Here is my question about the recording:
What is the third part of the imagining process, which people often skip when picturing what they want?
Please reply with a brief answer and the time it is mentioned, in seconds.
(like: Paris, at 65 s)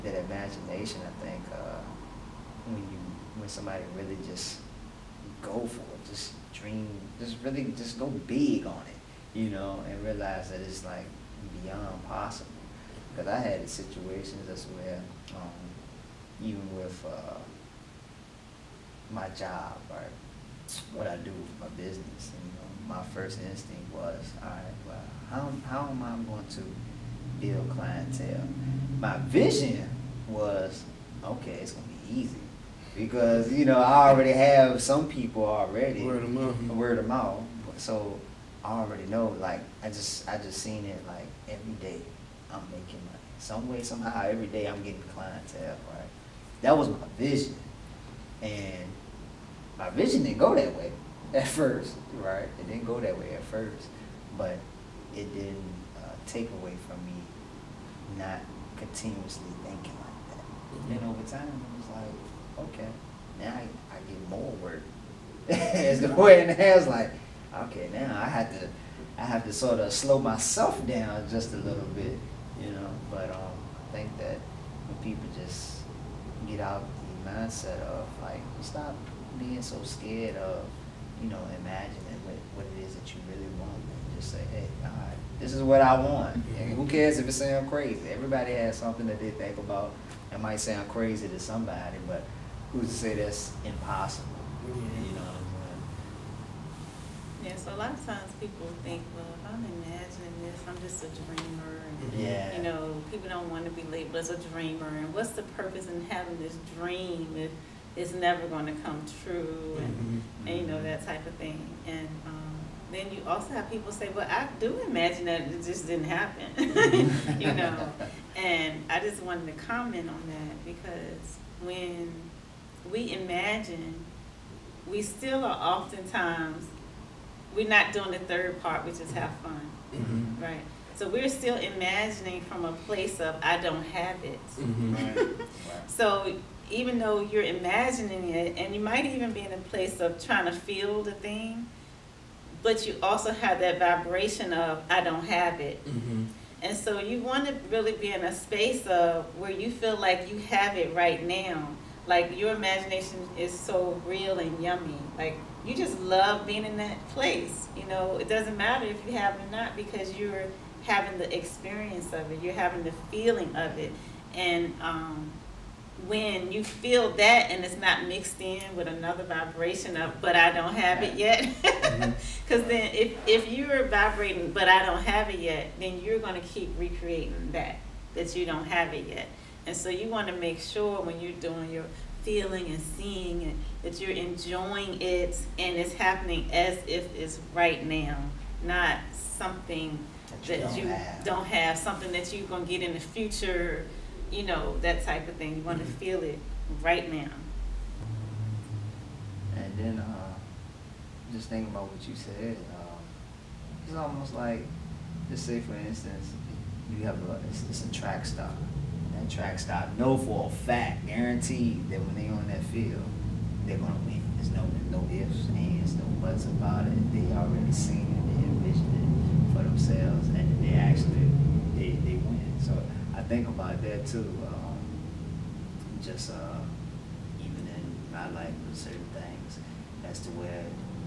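Have fun, at 129 s.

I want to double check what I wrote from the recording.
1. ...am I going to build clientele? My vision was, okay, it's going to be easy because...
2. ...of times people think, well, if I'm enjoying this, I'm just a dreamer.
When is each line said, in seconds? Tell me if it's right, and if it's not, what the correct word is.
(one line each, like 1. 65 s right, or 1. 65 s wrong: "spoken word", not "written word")
1. 25 s right
2. 97 s wrong: "imagining", not "enjoying".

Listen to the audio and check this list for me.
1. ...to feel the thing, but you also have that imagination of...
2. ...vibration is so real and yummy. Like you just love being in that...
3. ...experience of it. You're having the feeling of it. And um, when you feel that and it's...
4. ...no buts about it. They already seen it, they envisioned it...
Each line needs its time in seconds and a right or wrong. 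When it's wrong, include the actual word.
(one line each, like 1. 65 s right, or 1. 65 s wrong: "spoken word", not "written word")
1. 140 s wrong: "vibration", not "imagination"
2. 152 s wrong: "imagination", not "vibration"
3. 161 s right
4. 215 s right.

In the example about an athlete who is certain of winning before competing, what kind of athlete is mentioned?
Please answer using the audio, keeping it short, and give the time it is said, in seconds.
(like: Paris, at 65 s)
Track star, at 208 s.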